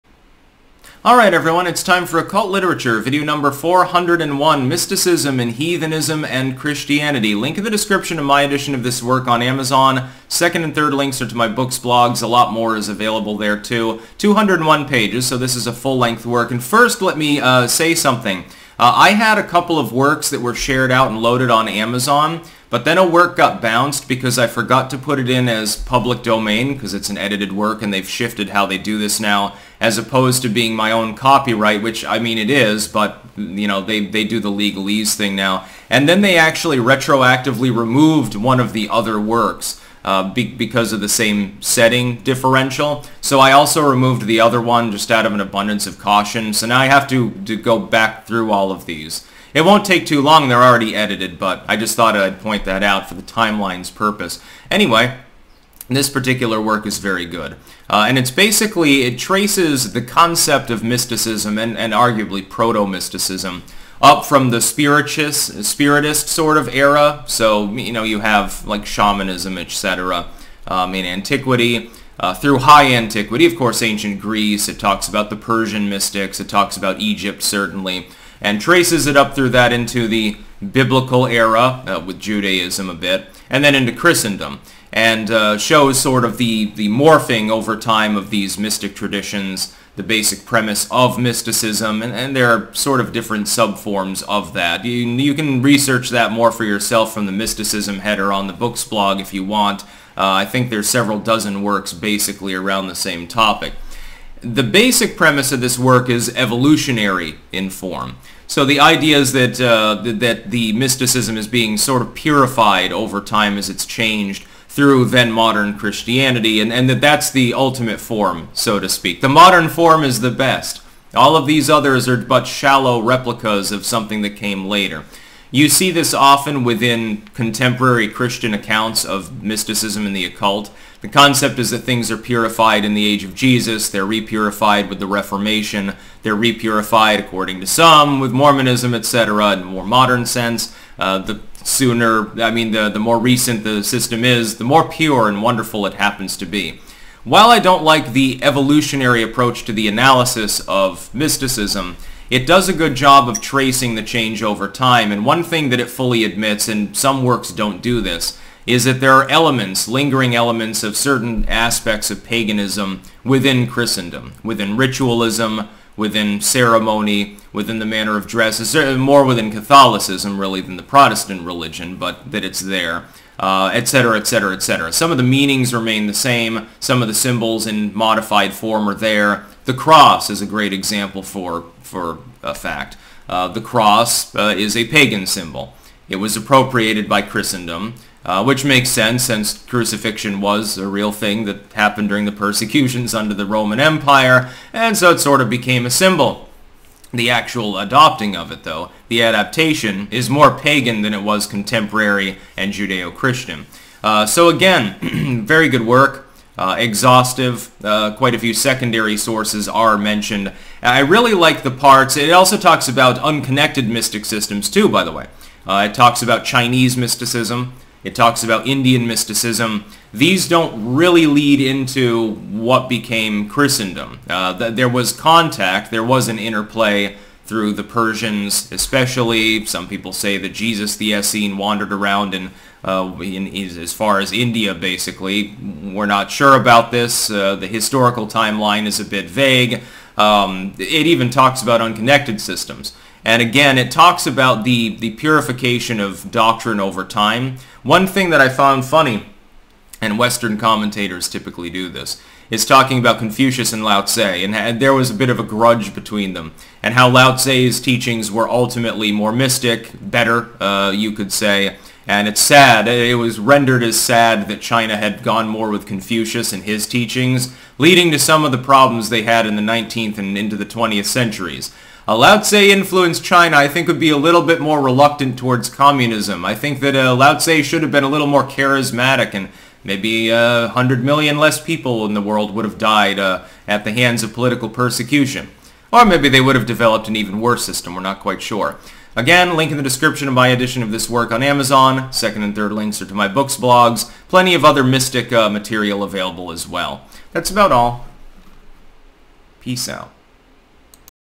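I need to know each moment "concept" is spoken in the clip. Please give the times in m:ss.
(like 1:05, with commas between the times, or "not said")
1:00, 2:11.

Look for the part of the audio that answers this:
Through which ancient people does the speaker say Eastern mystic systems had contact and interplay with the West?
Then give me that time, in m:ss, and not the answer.
3:47.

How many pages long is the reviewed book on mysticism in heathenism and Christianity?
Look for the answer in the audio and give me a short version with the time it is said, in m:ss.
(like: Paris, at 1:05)
201, at 0:14.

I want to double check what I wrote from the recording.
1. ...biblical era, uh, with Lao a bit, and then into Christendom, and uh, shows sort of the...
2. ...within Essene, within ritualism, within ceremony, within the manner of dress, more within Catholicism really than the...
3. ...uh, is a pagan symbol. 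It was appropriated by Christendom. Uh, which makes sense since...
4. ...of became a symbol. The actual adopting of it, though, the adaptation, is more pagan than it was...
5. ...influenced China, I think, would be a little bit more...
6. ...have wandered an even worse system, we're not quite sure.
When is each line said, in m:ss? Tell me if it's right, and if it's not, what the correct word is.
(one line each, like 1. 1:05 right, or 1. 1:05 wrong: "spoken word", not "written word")
1. 1:20 wrong: "Judaism", not "Lao"
2. 2:43 wrong: "Christendom", not "Essene"
3. 3:04 right
4. 3:15 right
5. 4:32 right
6. 4:46 wrong: "developed", not "wandered".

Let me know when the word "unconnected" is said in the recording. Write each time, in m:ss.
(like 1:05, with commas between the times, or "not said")
3:33, 4:01.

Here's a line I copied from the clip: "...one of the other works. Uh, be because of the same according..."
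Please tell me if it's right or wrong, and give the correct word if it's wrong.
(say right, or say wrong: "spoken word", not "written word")
wrong: "setting", not "according".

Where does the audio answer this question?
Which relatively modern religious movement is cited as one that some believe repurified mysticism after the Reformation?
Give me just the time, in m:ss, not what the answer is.
2:18.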